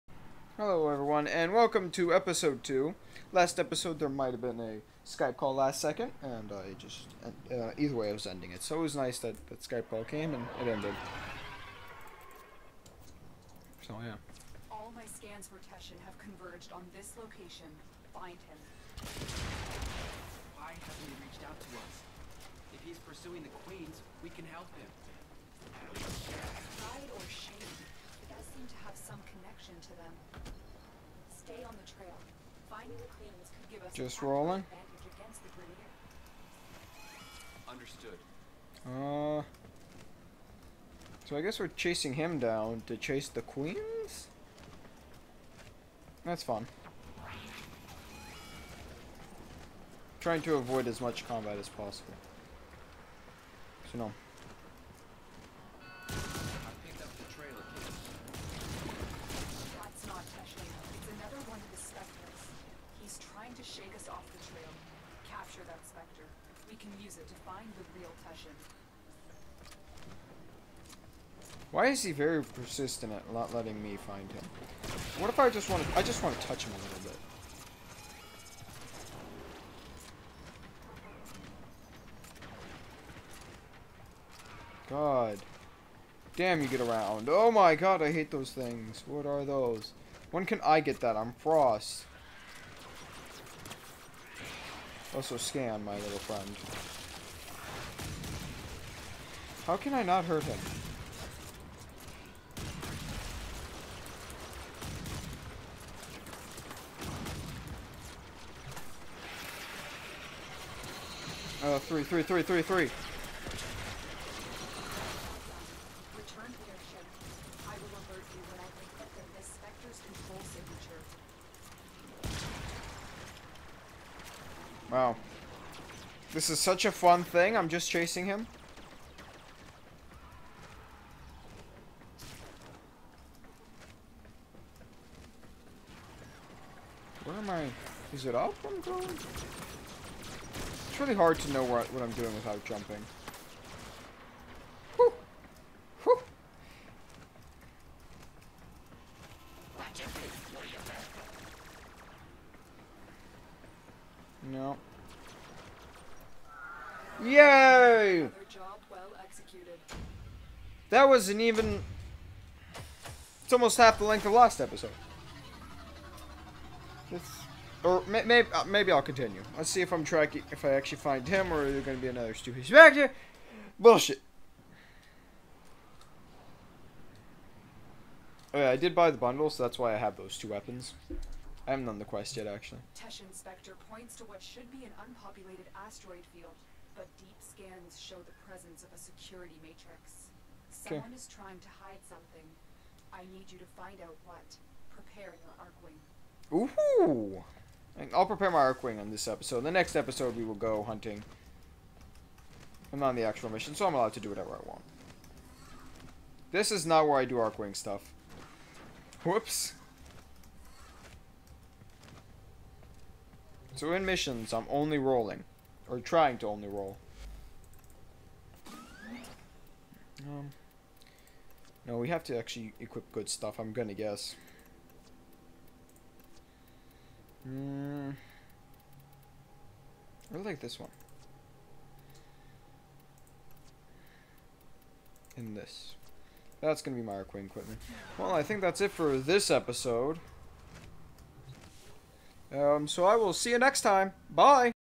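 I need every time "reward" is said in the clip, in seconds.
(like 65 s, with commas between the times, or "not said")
not said.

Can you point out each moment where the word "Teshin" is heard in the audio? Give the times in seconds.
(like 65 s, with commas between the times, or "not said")
15 s, 68 s, 182 s.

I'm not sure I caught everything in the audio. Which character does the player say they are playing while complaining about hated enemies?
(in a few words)
Frost.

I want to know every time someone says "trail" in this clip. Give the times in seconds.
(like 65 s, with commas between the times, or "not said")
31 s, 64 s.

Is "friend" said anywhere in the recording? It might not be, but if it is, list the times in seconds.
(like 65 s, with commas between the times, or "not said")
96 s.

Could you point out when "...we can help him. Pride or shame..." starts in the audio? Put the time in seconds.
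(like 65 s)
24 s.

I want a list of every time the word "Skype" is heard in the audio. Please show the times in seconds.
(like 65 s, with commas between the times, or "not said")
5 s, 9 s.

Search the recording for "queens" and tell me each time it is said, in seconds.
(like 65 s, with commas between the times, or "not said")
23 s, 33 s, 43 s.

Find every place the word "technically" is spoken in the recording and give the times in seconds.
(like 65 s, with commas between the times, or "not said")
not said.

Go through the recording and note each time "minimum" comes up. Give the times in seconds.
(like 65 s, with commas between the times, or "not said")
not said.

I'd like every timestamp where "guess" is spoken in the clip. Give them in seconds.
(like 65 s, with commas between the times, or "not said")
41 s, 223 s.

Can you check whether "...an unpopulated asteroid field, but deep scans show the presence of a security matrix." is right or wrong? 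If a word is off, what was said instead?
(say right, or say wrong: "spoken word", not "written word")
right.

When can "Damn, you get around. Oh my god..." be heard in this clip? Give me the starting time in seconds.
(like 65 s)
86 s.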